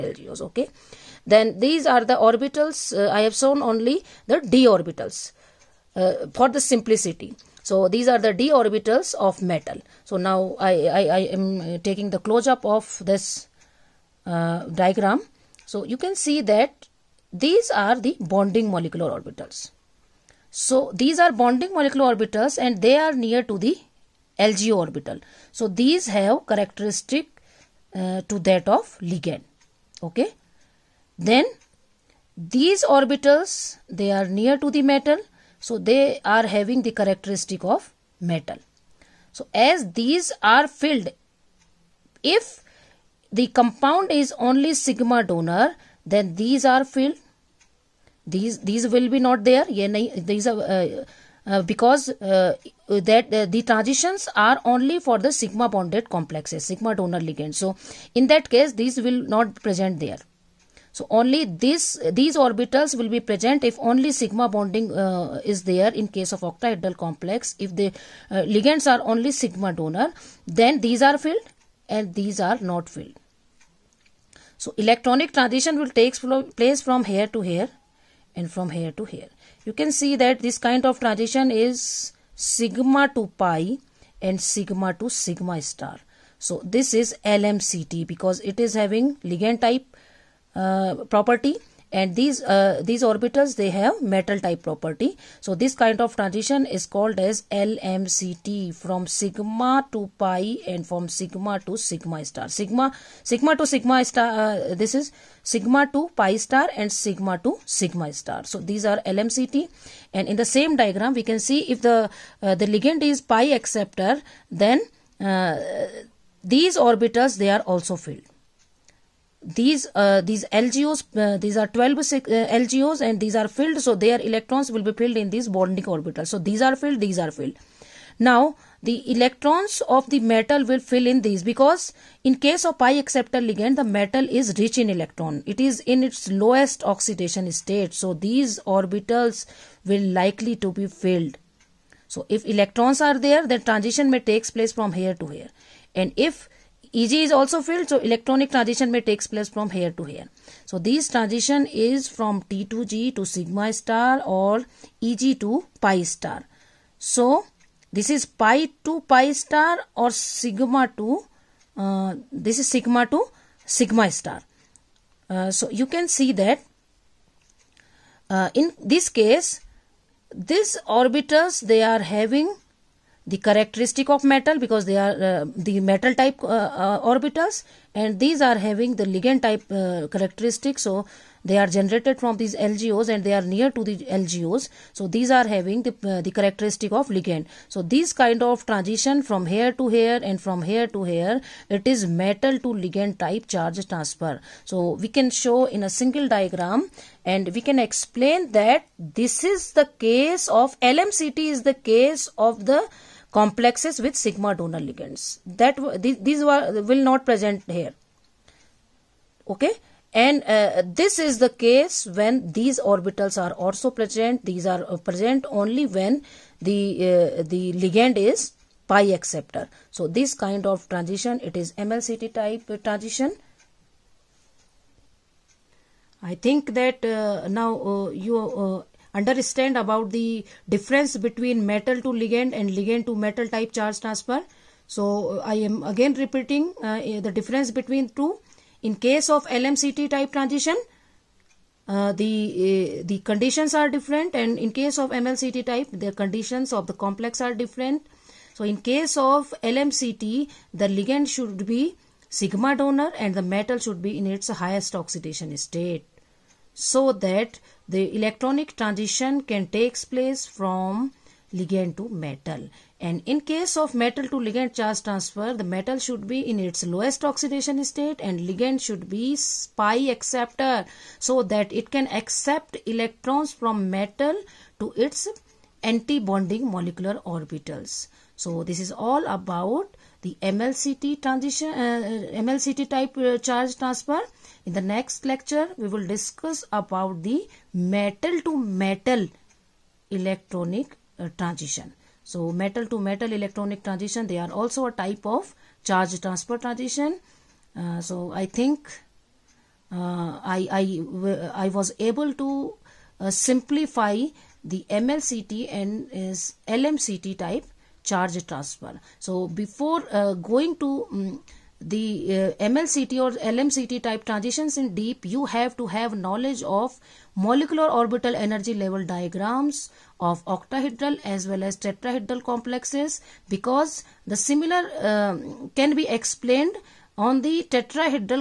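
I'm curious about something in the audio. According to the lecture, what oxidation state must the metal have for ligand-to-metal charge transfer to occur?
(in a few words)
highest oxidation state.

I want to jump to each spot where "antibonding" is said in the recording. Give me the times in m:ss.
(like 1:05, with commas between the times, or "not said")
4:35.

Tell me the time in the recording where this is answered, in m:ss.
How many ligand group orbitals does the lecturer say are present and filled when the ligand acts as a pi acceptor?
2:01.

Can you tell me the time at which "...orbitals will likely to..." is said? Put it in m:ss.
2:18.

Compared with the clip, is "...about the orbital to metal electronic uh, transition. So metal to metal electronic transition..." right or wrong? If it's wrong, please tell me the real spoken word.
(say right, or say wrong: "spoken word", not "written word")
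wrong: "metal", not "orbital".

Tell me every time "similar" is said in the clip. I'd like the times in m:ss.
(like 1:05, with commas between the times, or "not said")
5:24.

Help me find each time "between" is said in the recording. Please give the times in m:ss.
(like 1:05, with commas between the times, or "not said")
3:51, 3:57.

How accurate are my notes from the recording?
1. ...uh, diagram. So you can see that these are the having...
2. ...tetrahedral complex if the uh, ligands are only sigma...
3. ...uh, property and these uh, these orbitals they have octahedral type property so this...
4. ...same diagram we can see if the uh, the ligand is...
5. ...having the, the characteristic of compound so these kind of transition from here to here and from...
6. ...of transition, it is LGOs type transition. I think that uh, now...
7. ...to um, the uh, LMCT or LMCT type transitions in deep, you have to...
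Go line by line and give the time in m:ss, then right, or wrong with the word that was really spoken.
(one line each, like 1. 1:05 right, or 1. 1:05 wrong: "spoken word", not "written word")
1. 0:14 wrong: "bonding", not "having"
2. 1:06 wrong: "octahedral", not "tetrahedral"
3. 1:30 wrong: "metal", not "octahedral"
4. 1:50 right
5. 3:05 wrong: "ligand", not "compound"
6. 3:40 wrong: "MLCT", not "LGOs"
7. 5:10 wrong: "MLCT", not "LMCT".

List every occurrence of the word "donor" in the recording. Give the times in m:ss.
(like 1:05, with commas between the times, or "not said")
0:45, 0:56, 1:09, 3:24, 4:12.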